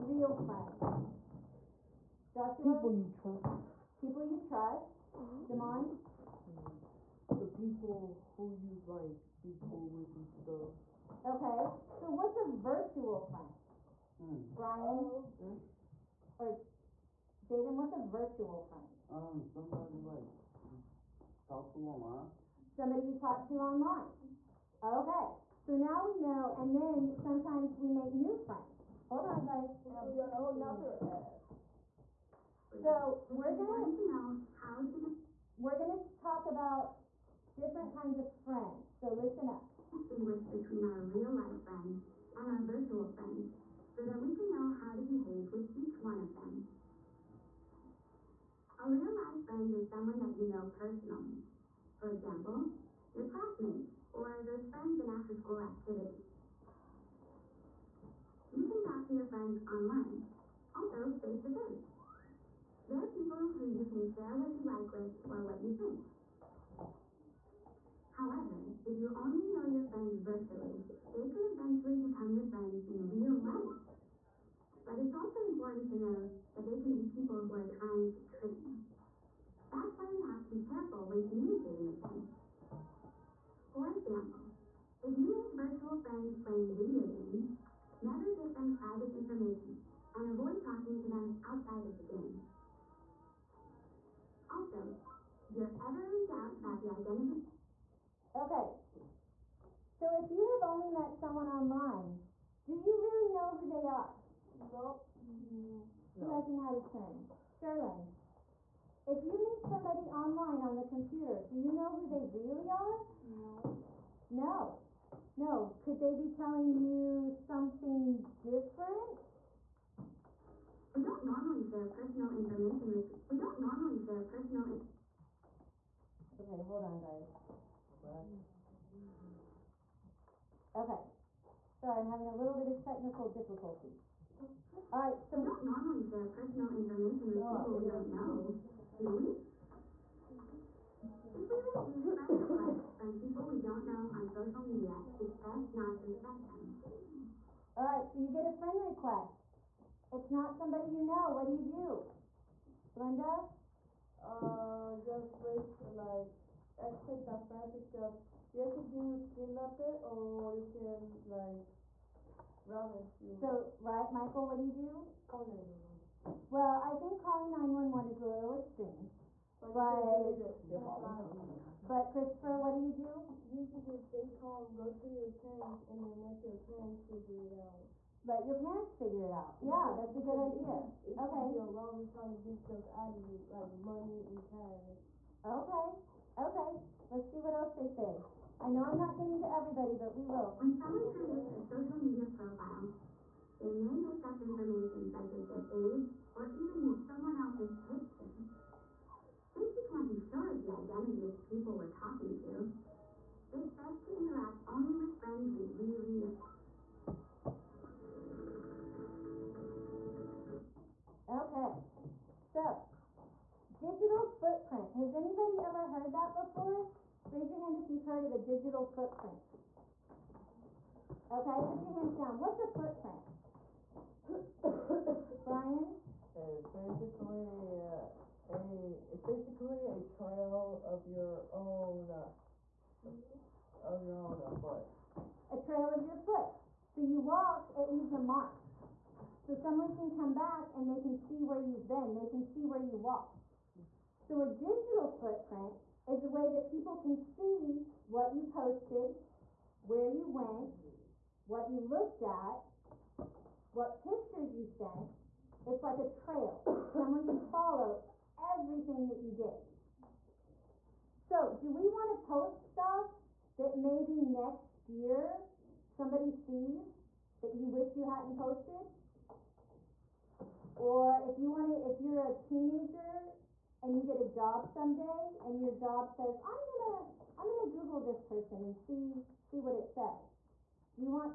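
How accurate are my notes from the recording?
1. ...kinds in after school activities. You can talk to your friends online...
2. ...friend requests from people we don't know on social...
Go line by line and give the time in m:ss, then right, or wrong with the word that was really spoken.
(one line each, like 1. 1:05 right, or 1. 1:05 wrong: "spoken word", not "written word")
1. 0:54 wrong: "friends", not "kinds"
2. 2:22 right.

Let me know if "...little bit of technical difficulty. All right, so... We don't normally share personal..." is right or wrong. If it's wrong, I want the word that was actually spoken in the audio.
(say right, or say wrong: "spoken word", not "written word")
right.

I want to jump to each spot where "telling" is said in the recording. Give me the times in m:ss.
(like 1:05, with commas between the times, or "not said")
1:56.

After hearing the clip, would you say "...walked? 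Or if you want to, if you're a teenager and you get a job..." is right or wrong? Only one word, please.
wrong.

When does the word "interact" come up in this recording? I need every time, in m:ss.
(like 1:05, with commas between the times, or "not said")
3:24.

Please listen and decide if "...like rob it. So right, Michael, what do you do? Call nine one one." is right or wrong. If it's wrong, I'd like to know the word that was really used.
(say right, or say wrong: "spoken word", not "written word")
right.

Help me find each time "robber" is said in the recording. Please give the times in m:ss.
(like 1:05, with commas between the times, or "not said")
3:01.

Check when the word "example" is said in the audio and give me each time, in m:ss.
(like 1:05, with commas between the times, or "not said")
0:52, 1:23.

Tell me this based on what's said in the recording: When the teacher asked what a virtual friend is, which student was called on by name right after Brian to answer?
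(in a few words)
Jaden.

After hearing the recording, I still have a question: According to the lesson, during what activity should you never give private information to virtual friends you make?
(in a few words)
video games.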